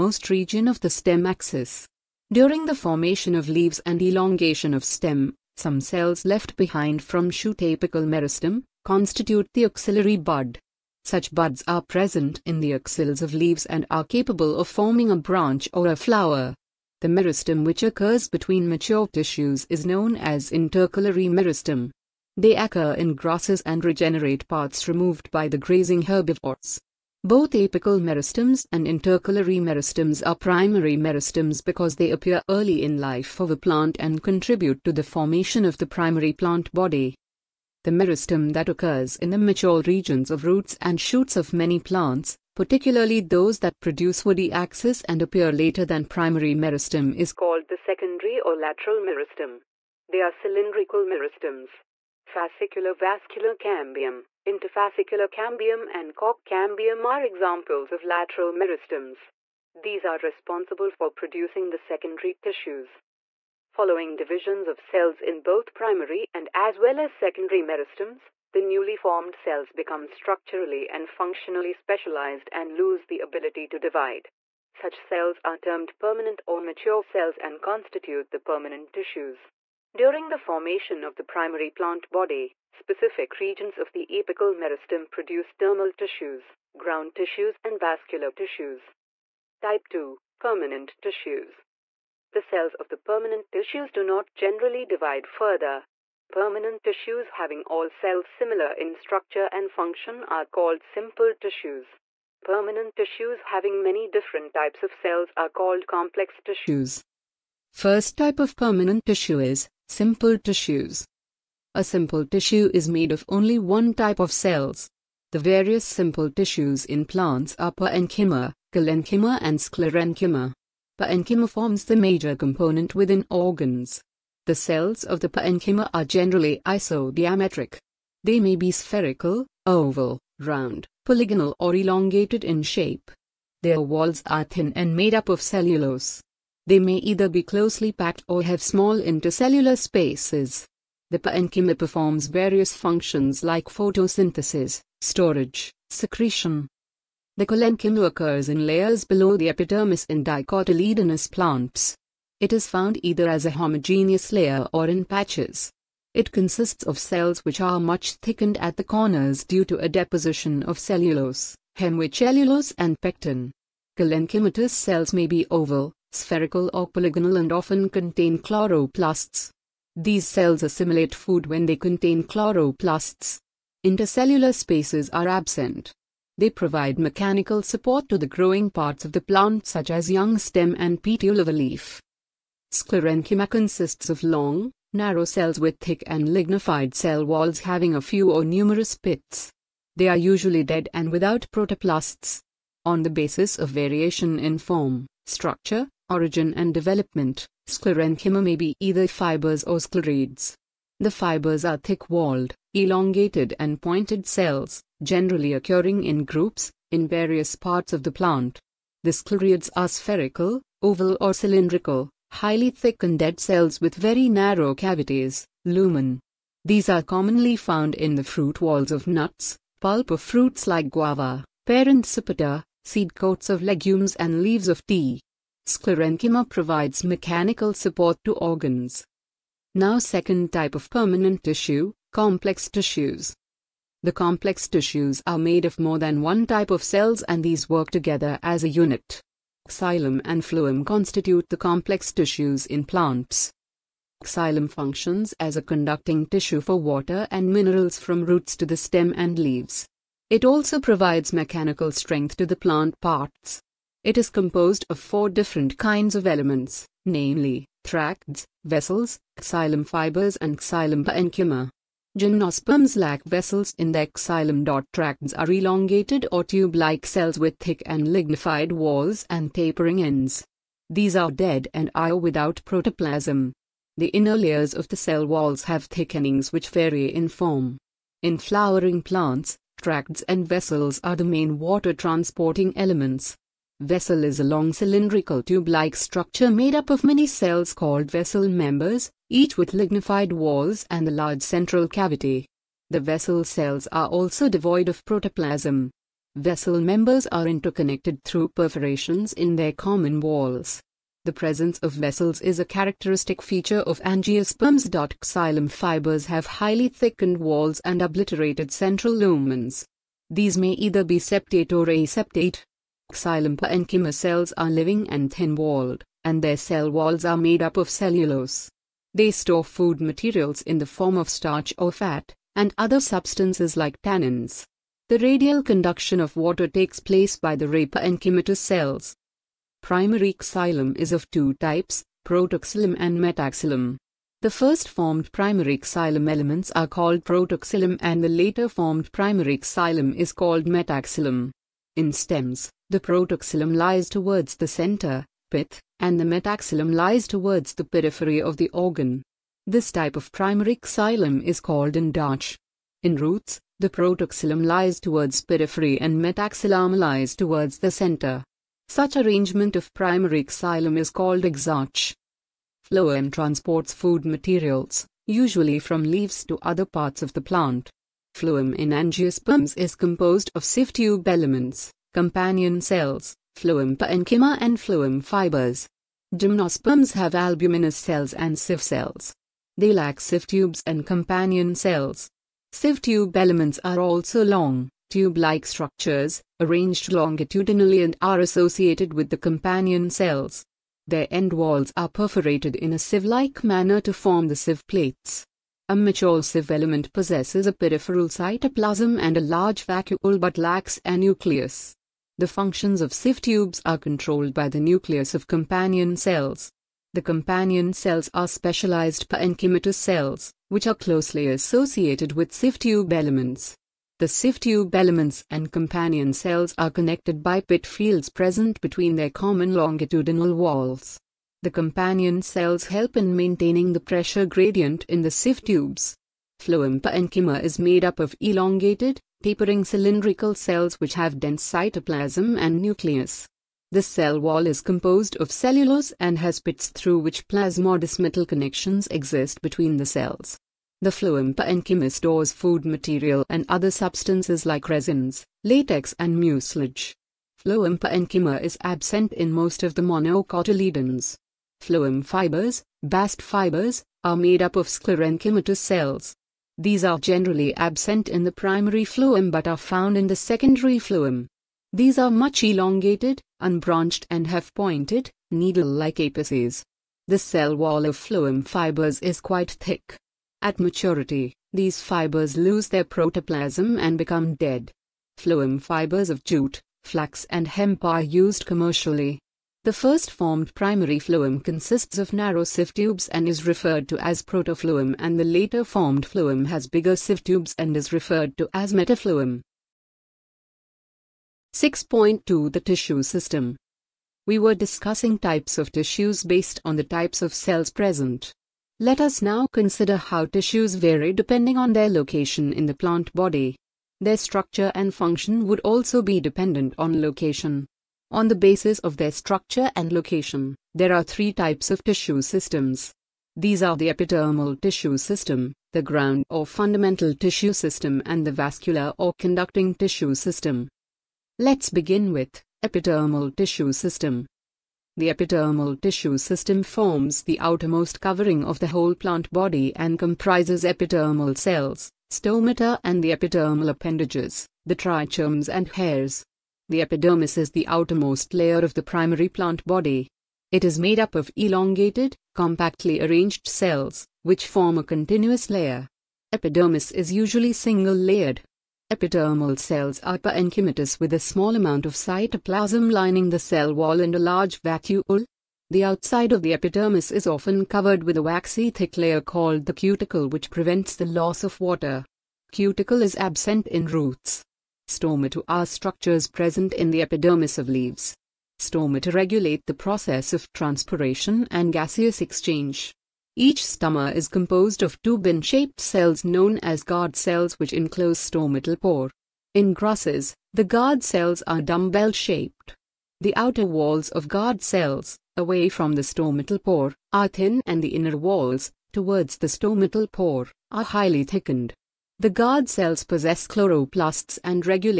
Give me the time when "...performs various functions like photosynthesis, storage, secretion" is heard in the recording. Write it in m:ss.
2:21.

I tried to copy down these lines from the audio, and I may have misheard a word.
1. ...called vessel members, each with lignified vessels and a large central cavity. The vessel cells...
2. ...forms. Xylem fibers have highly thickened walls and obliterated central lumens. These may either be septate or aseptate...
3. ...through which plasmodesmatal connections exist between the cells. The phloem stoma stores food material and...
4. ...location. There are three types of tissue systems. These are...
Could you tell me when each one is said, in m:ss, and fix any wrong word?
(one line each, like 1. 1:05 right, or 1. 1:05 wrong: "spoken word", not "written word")
1. 4:47 wrong: "walls", not "vessels"
2. 5:04 wrong: "angiosperms", not "forms"
3. 7:16 wrong: "parenchyma", not "stoma"
4. 8:30 right.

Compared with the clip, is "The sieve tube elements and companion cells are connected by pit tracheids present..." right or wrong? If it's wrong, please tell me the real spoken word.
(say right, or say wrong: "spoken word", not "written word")
wrong: "fields", not "tracheids".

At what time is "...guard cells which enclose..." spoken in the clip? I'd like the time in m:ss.
9:37.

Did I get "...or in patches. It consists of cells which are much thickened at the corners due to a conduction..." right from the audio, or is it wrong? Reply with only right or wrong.
wrong.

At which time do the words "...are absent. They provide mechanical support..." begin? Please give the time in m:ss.
2:55.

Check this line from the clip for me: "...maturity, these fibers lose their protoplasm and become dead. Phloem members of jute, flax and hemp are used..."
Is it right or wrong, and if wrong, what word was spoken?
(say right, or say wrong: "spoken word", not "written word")
wrong: "fibers", not "members".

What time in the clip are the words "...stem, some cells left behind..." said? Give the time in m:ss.
0:04.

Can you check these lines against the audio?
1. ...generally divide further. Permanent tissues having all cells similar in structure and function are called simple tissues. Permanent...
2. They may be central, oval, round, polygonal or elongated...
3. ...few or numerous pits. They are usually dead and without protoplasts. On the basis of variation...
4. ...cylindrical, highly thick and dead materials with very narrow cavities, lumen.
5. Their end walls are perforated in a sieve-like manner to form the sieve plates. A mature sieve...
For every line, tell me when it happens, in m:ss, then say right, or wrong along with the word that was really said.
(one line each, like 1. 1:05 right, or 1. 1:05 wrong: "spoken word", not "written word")
1. 1:34 right
2. 2:08 wrong: "spherical", not "central"
3. 3:08 right
4. 3:31 wrong: "cells", not "materials"
5. 6:31 right.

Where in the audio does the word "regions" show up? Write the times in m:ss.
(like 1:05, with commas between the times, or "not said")
0:00, 0:39, 1:23.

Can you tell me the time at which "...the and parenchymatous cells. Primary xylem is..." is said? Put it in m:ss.
5:27.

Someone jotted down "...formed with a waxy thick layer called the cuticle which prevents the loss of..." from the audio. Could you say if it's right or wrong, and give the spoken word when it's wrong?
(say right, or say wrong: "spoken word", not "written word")
wrong: "covered", not "formed".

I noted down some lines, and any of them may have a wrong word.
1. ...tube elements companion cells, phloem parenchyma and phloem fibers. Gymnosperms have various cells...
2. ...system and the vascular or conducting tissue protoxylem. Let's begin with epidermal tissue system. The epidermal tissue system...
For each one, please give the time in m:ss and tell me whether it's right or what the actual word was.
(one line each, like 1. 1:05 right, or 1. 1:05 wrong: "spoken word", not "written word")
1. 6:10 wrong: "albuminous", not "various"
2. 8:37 wrong: "system", not "protoxylem".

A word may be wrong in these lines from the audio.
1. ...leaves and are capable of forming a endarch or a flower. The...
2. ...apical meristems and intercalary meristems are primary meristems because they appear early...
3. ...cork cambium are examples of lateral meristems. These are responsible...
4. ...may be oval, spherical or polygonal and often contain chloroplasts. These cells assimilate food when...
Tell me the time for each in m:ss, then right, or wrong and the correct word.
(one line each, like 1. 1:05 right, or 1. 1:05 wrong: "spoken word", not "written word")
1. 0:13 wrong: "branch", not "endarch"
2. 0:27 right
3. 0:56 right
4. 2:45 right.